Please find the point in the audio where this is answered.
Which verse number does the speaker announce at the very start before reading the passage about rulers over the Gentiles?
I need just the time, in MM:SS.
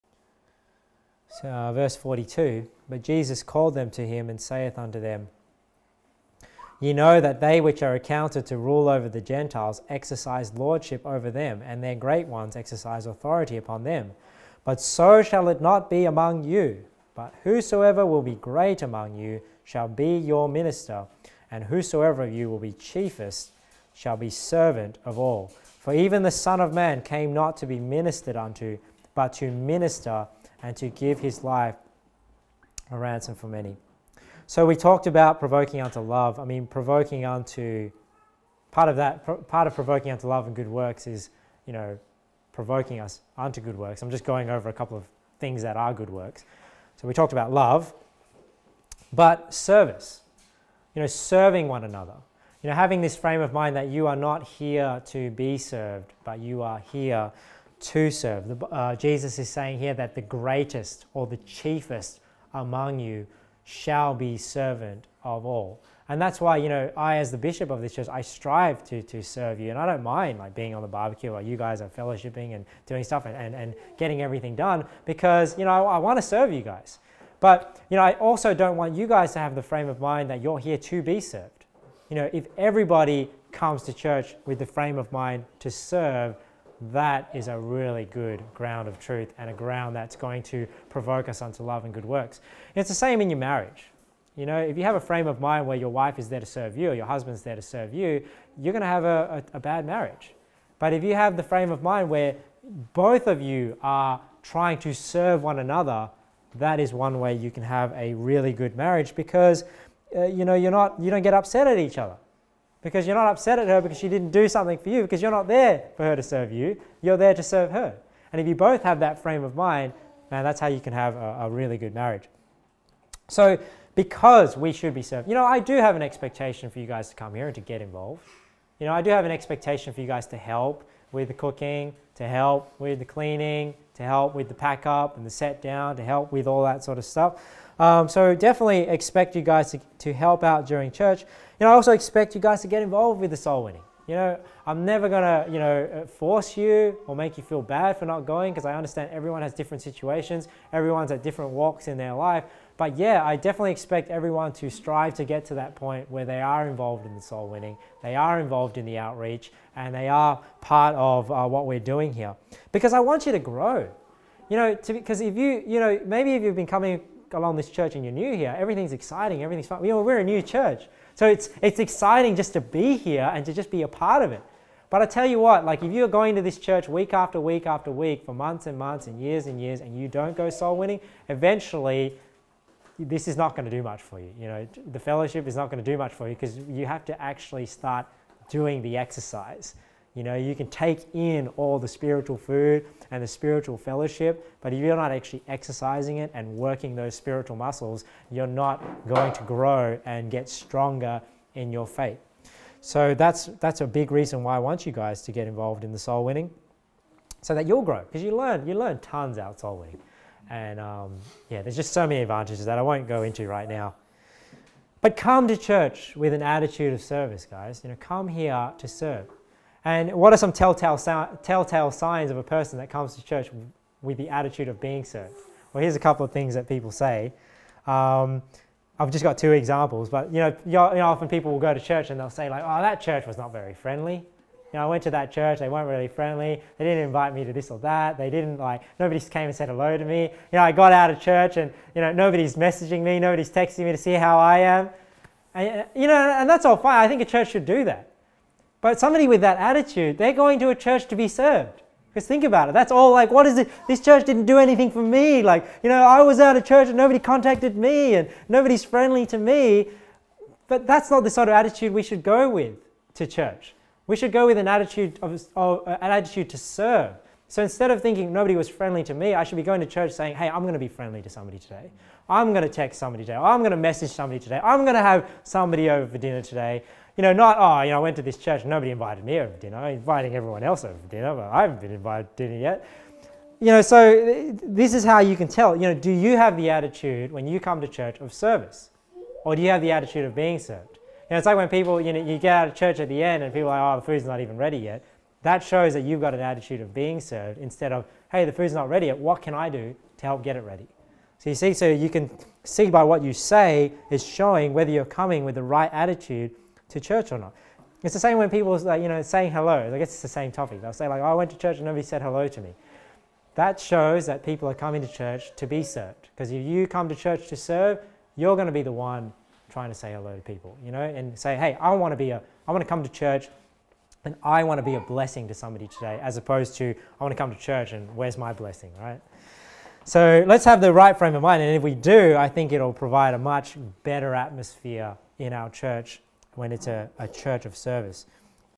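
00:01.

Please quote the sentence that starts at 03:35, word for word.
But come to church with an attitude of service, guys.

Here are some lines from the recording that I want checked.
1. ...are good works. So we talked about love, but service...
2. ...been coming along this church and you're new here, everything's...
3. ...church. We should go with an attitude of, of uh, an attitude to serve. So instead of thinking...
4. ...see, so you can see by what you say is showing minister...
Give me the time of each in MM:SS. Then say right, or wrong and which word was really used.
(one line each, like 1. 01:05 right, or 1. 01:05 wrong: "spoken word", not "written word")
1. 00:45 right
2. 02:46 right
3. 04:23 right
4. 05:01 wrong: "whether", not "minister".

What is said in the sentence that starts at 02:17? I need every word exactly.
Um, so definitely expect you guys to, to help out during church.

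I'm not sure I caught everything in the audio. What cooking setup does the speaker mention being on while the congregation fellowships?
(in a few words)
Barbecue.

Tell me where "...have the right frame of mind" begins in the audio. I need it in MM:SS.
05:30.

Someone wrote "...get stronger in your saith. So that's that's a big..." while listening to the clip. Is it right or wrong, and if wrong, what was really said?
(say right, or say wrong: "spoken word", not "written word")
wrong: "faith", not "saith".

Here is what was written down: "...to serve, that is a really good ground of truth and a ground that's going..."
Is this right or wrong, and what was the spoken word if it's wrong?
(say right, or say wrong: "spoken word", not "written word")
right.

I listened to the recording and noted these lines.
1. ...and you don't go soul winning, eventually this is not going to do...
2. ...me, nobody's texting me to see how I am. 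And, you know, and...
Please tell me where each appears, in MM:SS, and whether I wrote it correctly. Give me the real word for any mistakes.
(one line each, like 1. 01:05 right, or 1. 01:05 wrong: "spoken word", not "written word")
1. 02:59 right
2. 04:03 right.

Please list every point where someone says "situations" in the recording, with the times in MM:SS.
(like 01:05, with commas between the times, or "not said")
02:29.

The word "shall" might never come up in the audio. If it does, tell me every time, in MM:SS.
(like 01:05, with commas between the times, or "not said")
00:15, 00:19, 00:23, 01:03.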